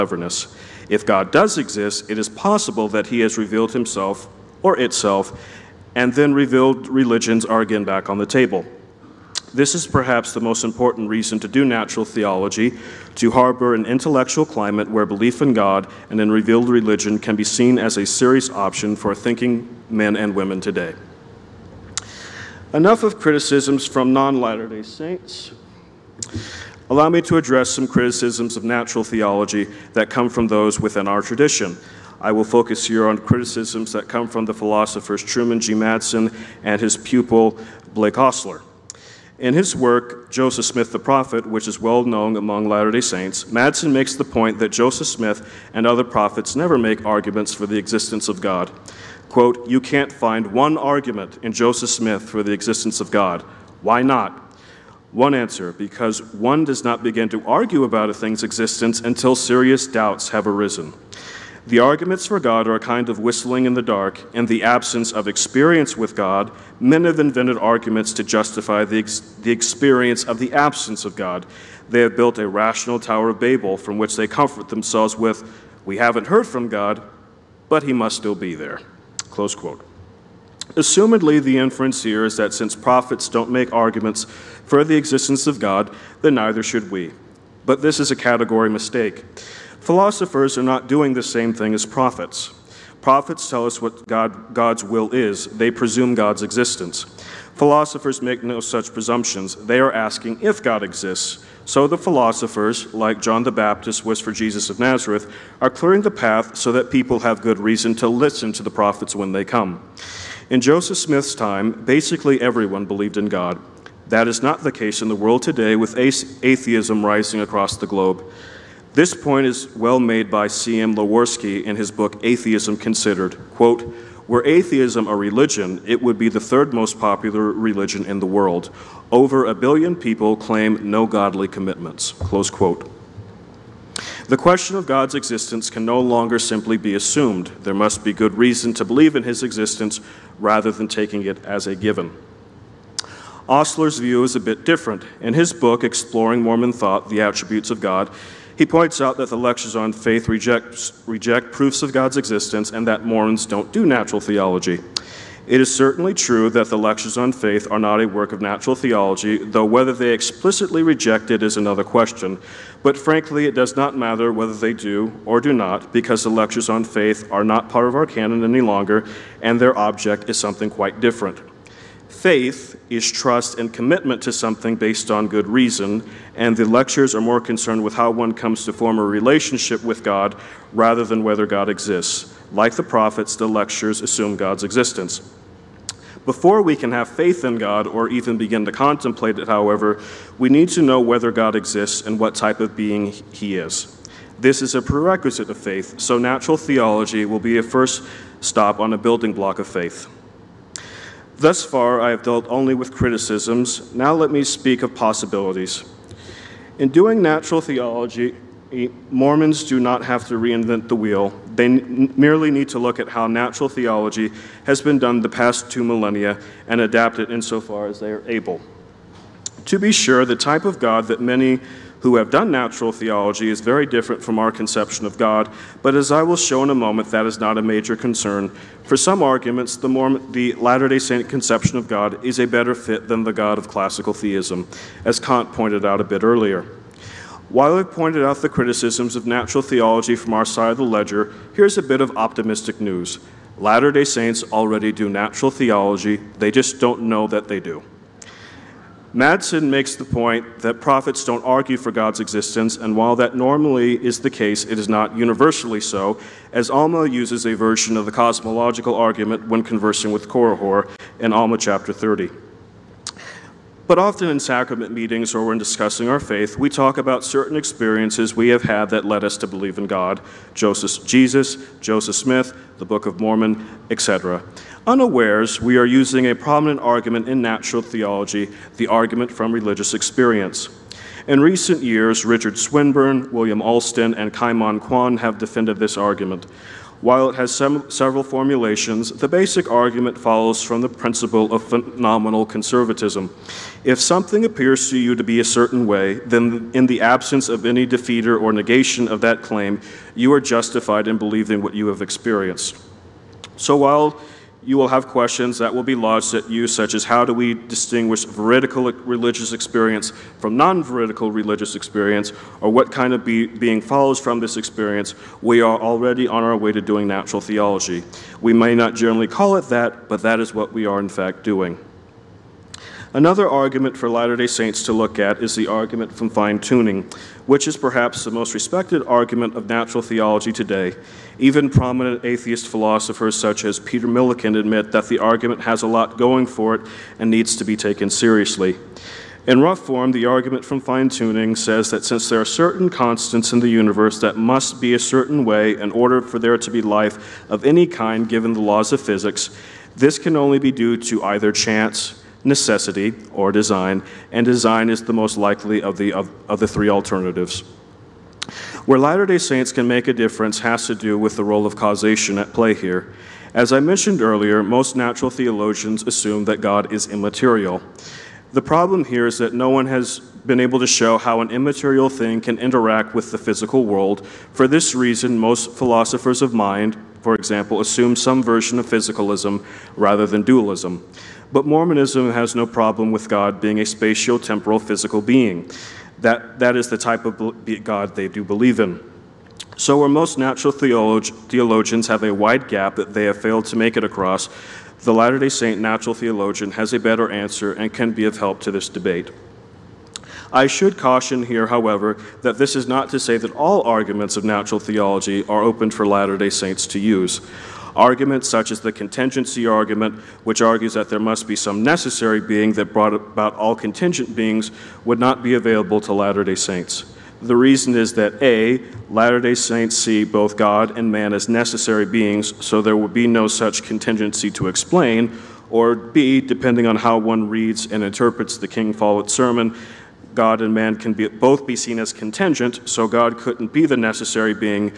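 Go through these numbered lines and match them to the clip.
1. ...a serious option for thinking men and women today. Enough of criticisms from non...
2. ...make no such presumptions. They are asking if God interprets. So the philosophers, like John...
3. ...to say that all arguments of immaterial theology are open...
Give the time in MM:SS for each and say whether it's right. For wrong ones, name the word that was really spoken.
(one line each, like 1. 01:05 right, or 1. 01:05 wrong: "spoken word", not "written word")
1. 00:17 right
2. 01:38 wrong: "exists", not "interprets"
3. 06:43 wrong: "natural", not "immaterial".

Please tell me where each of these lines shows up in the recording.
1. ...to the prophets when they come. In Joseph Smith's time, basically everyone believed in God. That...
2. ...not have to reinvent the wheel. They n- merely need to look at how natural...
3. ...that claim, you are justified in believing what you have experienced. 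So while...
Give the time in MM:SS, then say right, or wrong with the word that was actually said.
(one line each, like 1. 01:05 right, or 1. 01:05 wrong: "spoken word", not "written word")
1. 01:48 right
2. 03:29 right
3. 04:59 right.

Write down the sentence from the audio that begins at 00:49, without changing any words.
Quote, You can't find one argument in Joseph Smith for the existence of God.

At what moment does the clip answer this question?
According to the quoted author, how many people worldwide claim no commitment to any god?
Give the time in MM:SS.
02:09.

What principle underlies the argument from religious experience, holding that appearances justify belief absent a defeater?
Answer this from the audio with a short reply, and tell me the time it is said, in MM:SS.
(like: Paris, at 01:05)
Phenomenal conservatism, at 04:51.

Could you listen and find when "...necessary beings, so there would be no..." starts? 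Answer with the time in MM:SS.
07:01.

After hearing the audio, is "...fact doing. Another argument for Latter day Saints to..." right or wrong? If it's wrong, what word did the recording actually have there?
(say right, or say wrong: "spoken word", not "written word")
right.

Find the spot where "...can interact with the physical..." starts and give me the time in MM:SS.
06:12.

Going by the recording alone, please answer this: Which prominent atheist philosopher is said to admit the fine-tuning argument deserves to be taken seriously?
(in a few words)
Peter Millican.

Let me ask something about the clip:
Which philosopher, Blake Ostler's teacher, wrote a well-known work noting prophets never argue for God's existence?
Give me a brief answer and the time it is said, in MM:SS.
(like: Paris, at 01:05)
Truman G. Madsen, at 00:35.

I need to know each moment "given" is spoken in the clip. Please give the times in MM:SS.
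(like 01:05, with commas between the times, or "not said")
02:21, 05:48.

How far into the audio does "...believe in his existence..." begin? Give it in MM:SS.
02:18.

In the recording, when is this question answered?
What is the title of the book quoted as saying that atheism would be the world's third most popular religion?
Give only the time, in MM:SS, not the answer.
02:02.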